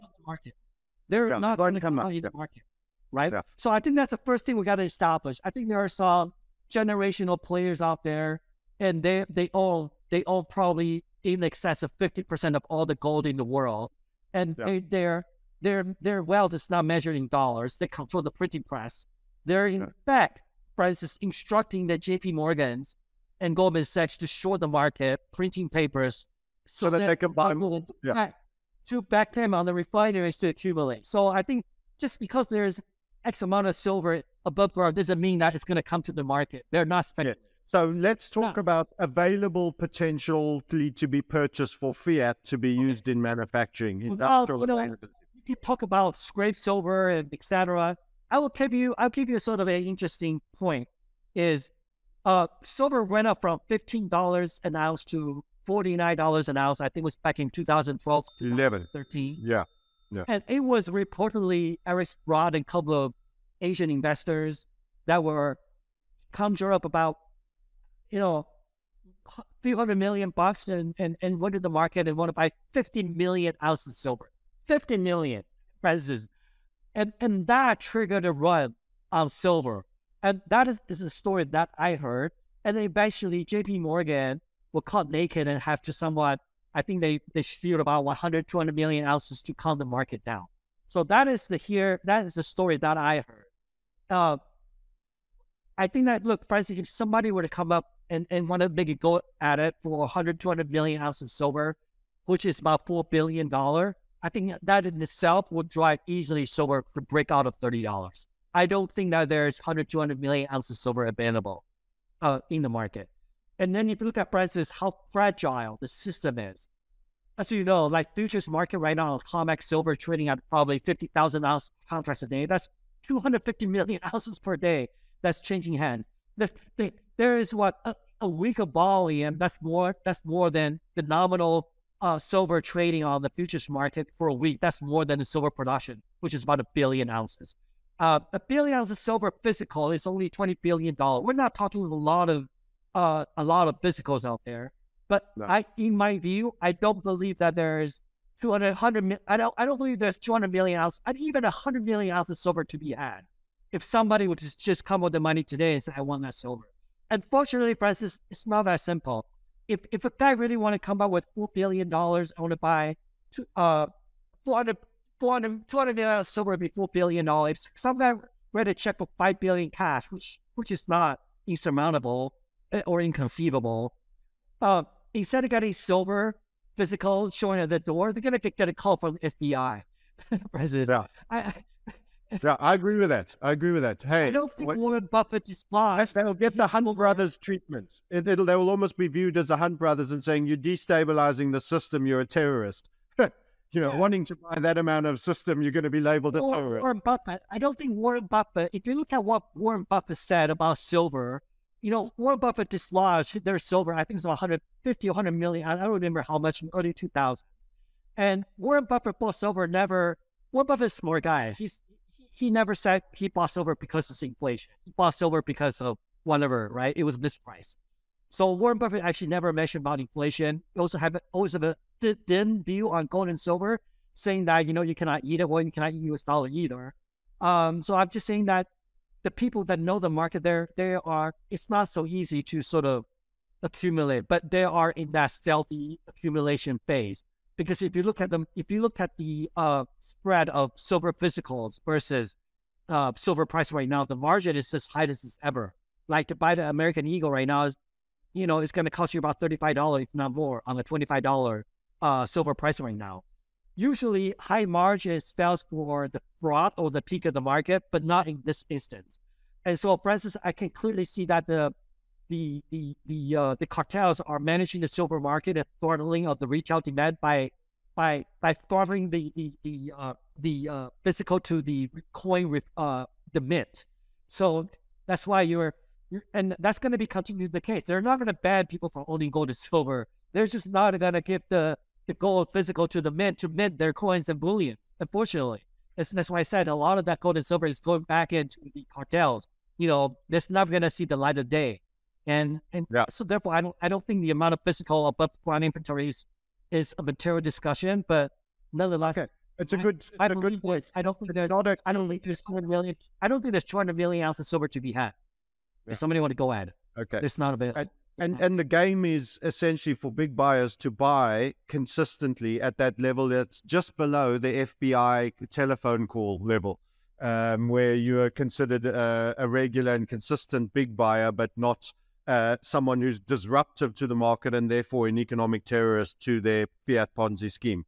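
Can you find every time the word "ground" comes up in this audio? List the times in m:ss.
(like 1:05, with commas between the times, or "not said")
0:34, 4:55.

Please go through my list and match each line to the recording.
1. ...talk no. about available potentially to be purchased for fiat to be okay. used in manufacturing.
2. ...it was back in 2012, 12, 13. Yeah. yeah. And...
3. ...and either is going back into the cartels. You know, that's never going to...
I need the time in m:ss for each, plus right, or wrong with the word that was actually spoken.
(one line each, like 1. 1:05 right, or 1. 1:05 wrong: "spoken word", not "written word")
1. 0:38 right
2. 0:57 wrong: "11", not "12"
3. 4:47 wrong: "silver", not "either".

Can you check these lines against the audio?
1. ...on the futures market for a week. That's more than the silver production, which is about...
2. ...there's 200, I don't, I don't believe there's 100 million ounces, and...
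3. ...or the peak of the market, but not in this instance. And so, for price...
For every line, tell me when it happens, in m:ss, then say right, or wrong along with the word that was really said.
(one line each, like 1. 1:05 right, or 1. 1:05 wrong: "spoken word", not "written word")
1. 2:13 right
2. 2:27 wrong: "200", not "100"
3. 4:16 wrong: "instance", not "price".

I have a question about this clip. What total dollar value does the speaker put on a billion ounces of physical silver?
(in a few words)
20 billion dollars.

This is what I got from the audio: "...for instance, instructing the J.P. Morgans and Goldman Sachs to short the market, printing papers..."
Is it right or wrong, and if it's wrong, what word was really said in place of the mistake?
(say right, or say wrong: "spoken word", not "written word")
right.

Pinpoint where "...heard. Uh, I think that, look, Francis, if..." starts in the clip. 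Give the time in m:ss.
1:33.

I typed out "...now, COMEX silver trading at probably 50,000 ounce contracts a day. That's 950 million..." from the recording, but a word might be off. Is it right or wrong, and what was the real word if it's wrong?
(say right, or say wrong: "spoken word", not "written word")
wrong: "250", not "950".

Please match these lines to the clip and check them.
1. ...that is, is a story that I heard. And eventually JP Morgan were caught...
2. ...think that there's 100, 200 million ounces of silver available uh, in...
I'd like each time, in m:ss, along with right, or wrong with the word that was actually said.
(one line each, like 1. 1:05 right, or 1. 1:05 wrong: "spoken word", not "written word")
1. 1:20 right
2. 1:48 right.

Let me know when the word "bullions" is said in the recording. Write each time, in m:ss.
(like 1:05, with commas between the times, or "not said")
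4:44.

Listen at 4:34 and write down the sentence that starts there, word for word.
So that's why you're and that's going to be continued the case.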